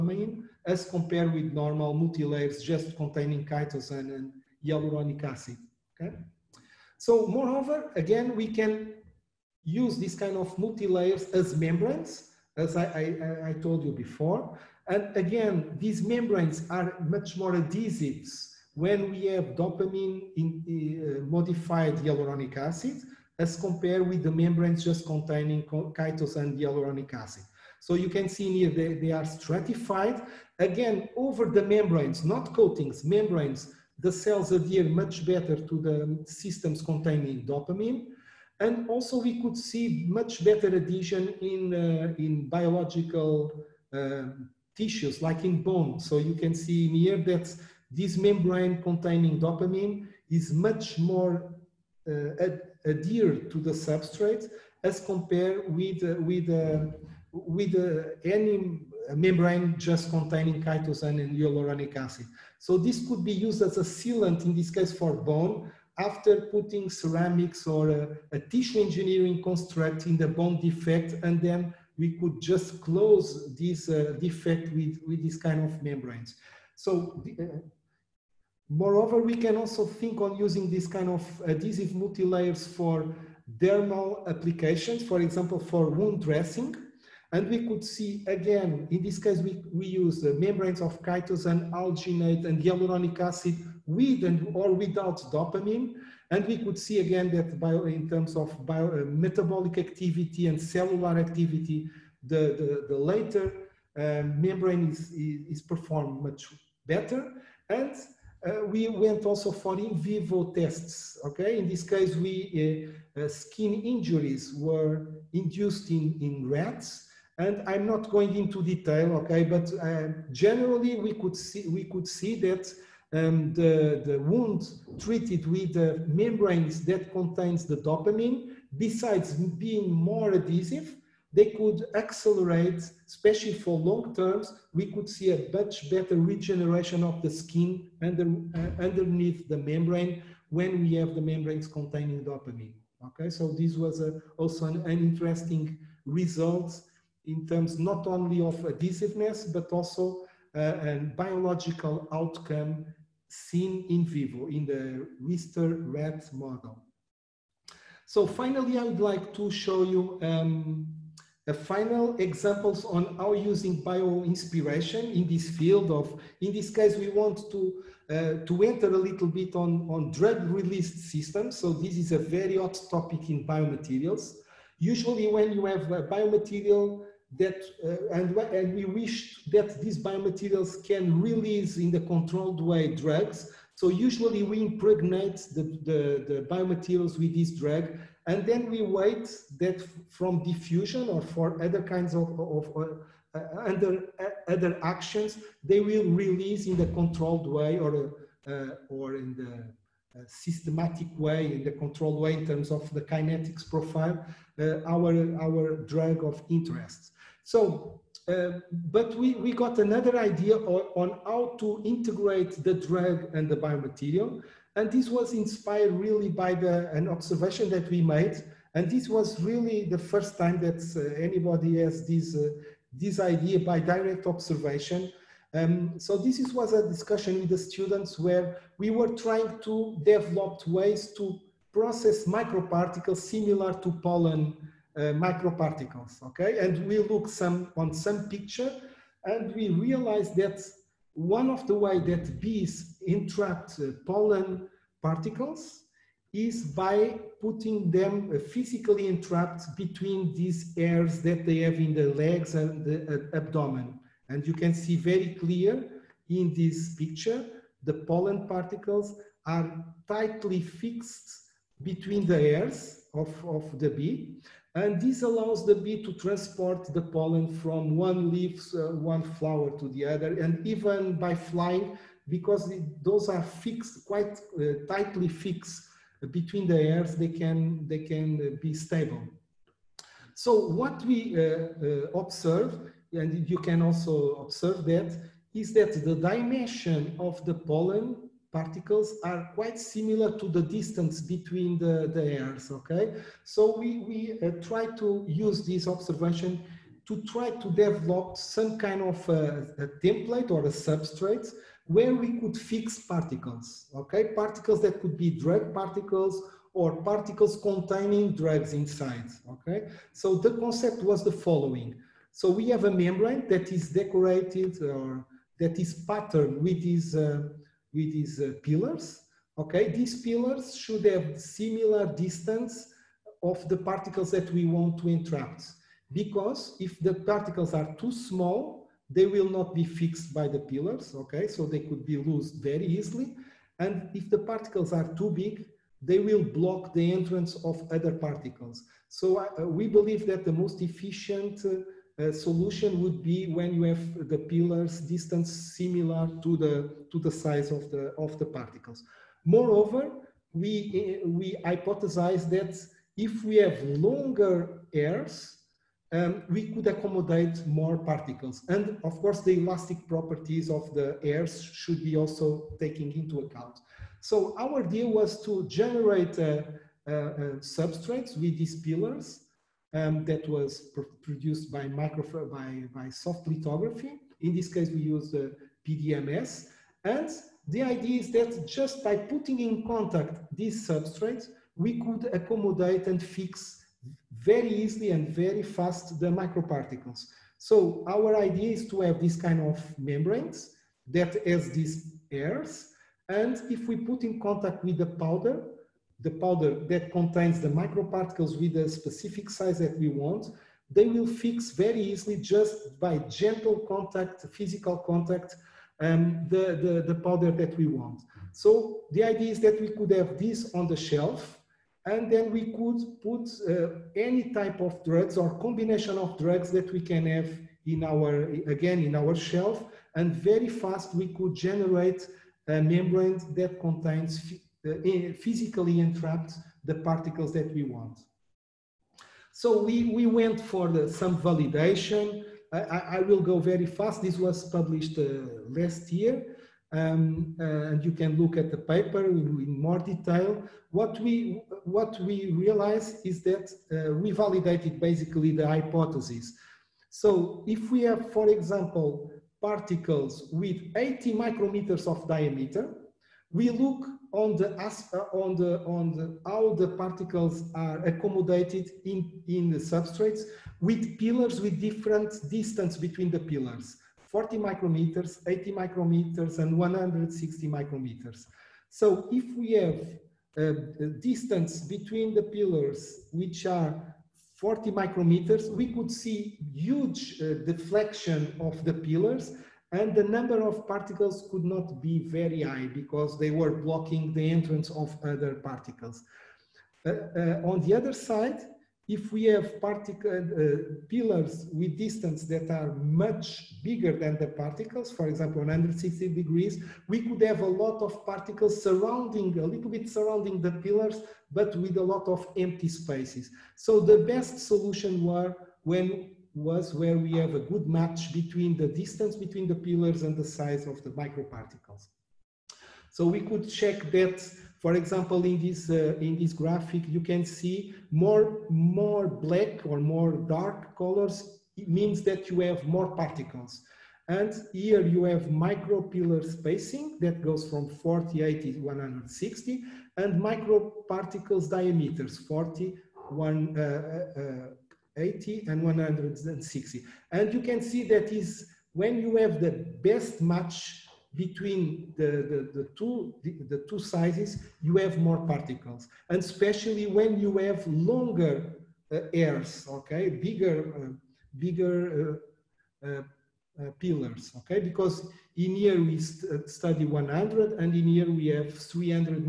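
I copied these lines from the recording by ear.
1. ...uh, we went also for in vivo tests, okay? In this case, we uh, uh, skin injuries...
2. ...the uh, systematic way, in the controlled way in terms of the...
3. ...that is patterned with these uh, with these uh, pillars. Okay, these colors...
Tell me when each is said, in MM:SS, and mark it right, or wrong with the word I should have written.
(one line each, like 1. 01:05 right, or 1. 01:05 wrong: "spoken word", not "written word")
1. 01:48 right
2. 03:19 right
3. 05:15 wrong: "pillars", not "colors".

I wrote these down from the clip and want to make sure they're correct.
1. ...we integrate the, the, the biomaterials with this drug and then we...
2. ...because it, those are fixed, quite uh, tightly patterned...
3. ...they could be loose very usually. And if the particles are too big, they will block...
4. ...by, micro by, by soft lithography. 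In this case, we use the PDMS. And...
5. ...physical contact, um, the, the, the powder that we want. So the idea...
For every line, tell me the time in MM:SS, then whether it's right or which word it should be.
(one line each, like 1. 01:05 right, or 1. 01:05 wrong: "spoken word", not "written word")
1. 03:04 wrong: "impregnate", not "integrate"
2. 04:32 wrong: "fixed", not "patterned"
3. 05:31 wrong: "easily", not "usually"
4. 06:11 right
5. 06:44 right.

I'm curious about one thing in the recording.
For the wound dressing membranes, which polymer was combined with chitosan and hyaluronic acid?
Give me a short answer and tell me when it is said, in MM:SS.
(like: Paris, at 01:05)
Alginate, at 01:31.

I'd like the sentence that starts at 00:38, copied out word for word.
And also we could see much better adhesion in, uh, in biological uh, tissues, like in bone.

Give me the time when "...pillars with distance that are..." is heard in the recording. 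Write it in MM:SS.
08:11.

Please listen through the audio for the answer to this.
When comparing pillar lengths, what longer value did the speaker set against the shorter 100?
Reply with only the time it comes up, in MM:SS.
09:18.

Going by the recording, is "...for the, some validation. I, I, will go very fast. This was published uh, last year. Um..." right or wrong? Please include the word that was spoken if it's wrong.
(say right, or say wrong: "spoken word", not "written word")
right.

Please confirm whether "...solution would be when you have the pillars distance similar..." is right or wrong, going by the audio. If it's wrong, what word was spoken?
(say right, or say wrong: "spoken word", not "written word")
right.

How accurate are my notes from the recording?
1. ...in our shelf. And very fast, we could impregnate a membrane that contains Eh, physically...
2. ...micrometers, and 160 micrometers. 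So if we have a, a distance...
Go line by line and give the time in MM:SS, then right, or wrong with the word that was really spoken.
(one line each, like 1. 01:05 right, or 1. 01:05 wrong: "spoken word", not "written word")
1. 06:59 wrong: "generate", not "impregnate"
2. 07:45 right.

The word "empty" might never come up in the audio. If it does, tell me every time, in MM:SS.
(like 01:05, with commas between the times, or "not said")
08:22.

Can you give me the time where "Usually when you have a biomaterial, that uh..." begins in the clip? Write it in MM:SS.
02:54.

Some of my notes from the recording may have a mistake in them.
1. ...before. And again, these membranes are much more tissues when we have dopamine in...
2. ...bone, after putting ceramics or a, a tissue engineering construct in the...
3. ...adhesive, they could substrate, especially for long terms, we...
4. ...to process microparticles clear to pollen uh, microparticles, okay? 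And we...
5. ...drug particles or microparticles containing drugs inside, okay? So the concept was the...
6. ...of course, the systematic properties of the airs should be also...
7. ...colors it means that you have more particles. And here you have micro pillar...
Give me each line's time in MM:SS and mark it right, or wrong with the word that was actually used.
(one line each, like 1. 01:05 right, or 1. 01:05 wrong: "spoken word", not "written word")
1. 00:13 wrong: "adhesives", not "tissues"
2. 01:05 right
3. 02:10 wrong: "accelerate", not "substrate"
4. 03:51 wrong: "similar", not "clear"
5. 05:05 wrong: "particles", not "microparticles"
6. 05:59 wrong: "elastic", not "systematic"
7. 08:40 right.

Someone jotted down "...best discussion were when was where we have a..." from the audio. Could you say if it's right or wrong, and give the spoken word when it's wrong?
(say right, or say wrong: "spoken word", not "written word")
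wrong: "solution", not "discussion".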